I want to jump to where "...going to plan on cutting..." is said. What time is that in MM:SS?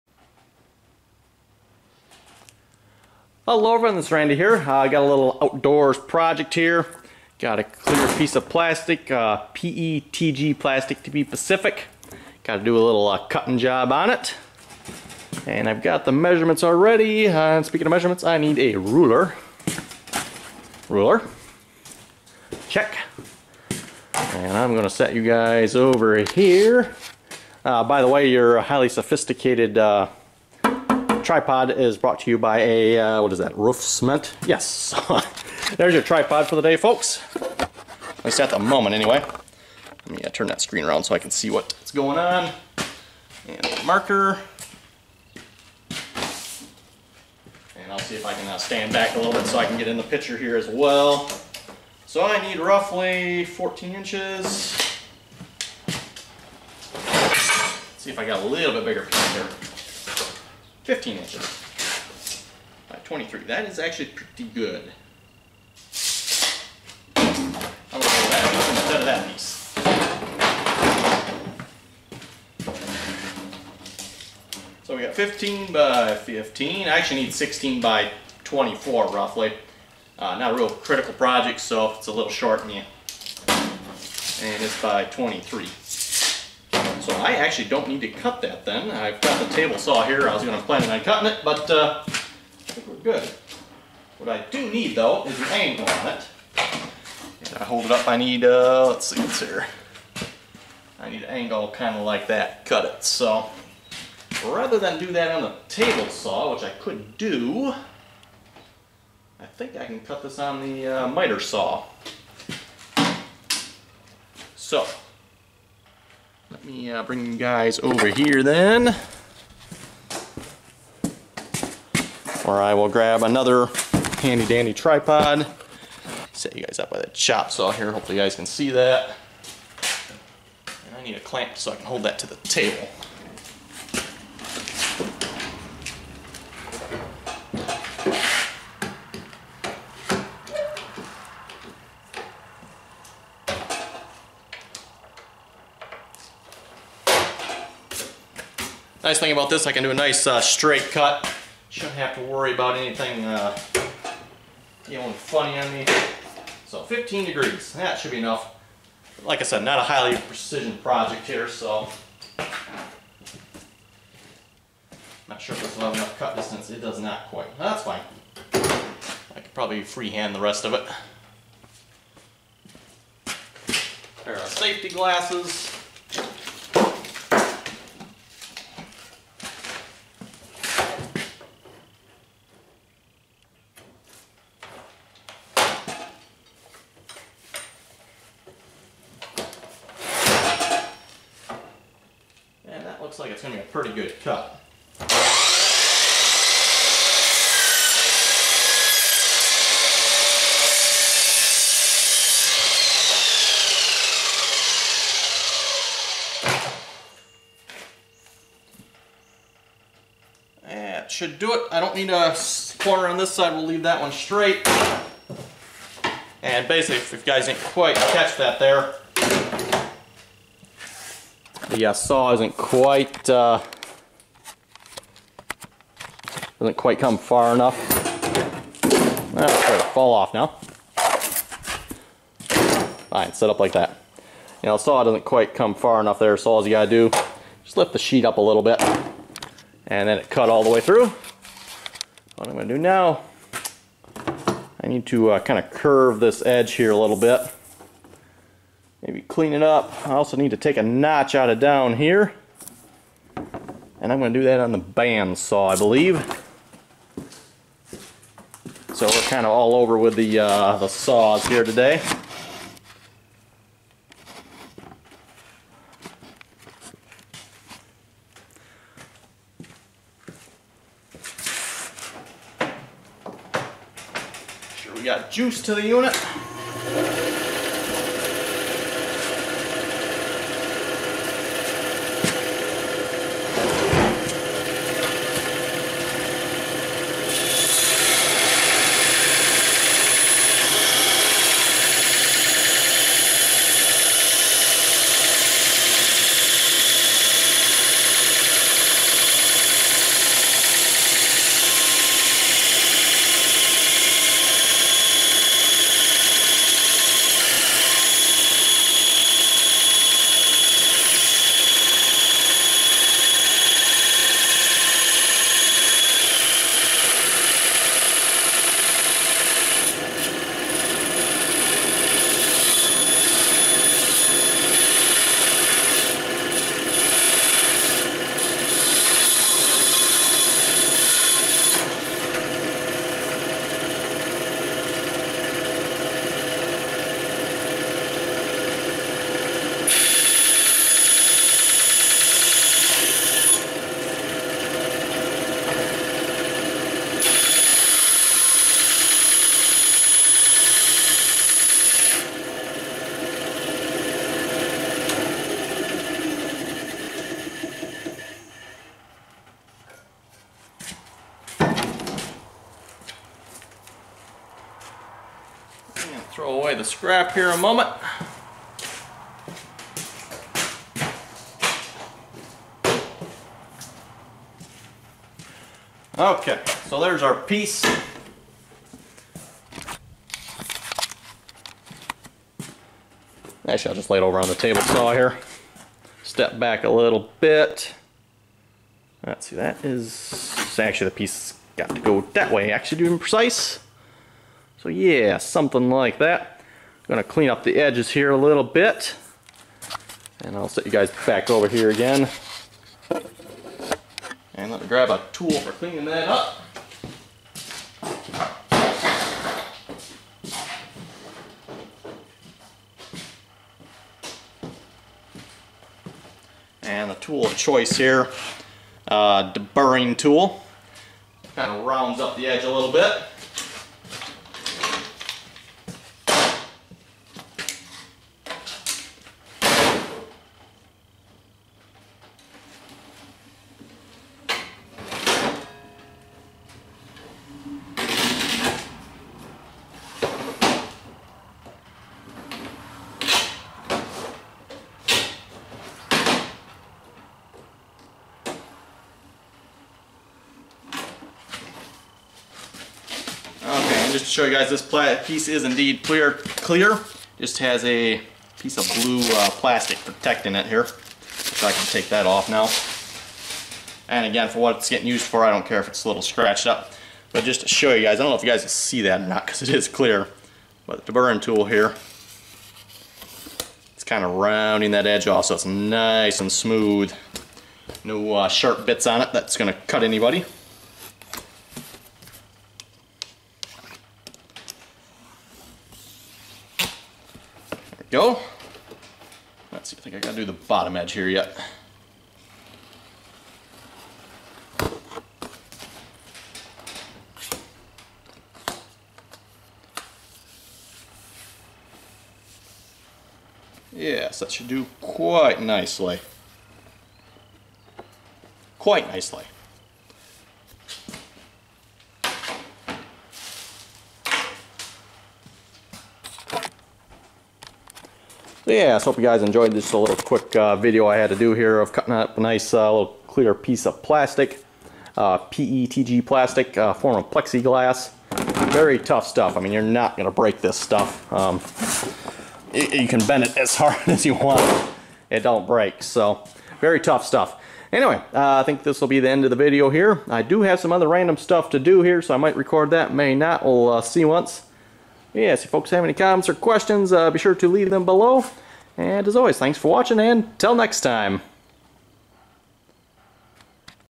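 01:30.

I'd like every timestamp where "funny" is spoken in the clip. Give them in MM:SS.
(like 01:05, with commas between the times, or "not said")
02:35.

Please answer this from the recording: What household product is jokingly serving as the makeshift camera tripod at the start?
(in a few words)
roof cement.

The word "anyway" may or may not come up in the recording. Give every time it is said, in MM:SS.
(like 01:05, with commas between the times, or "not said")
00:38, 08:57.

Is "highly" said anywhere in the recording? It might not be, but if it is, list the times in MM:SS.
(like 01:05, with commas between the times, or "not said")
00:28, 02:39.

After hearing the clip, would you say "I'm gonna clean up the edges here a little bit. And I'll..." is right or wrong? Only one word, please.
right.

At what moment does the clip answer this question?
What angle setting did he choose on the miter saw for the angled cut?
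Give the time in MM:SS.
02:36.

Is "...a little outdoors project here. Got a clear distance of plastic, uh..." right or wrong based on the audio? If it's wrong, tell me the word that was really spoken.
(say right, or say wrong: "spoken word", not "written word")
wrong: "piece", not "distance".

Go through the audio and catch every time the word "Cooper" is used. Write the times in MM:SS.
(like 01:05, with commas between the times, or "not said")
not said.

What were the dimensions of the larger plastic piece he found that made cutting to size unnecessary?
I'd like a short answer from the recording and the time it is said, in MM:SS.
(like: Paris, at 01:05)
15 by 23 inches, at 01:00.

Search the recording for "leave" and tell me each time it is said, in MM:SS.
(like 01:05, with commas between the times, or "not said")
03:33, 09:07.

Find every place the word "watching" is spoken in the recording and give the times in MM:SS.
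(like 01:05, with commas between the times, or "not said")
09:09.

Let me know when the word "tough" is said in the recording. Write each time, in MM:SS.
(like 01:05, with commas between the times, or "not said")
08:48, 08:57.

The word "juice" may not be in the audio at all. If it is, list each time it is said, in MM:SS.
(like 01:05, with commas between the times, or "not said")
04:35.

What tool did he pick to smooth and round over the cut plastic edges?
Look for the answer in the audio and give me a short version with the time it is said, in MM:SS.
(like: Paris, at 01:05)
deburring tool, at 06:59.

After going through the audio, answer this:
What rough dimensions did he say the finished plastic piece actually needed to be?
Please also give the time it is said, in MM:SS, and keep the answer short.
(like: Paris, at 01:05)
16 by 24, at 01:17.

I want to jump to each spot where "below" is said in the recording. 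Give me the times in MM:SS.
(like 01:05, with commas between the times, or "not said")
09:08.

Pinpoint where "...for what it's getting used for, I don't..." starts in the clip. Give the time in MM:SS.
07:44.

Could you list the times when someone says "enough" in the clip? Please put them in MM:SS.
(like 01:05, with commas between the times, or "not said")
02:38, 02:45, 03:47, 03:55.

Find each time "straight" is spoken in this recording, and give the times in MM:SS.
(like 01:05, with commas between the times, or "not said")
02:30, 03:34.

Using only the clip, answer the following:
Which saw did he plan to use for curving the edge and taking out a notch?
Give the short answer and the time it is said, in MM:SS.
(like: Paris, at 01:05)
band saw, at 04:14.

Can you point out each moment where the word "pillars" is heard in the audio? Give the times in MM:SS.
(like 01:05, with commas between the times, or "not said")
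not said.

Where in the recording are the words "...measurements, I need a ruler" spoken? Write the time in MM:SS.
00:17.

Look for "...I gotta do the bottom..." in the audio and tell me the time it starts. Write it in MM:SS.
08:10.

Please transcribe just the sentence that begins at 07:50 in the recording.
But the burn tool here, it's kind of rounding that edge off so it's nice and smooth.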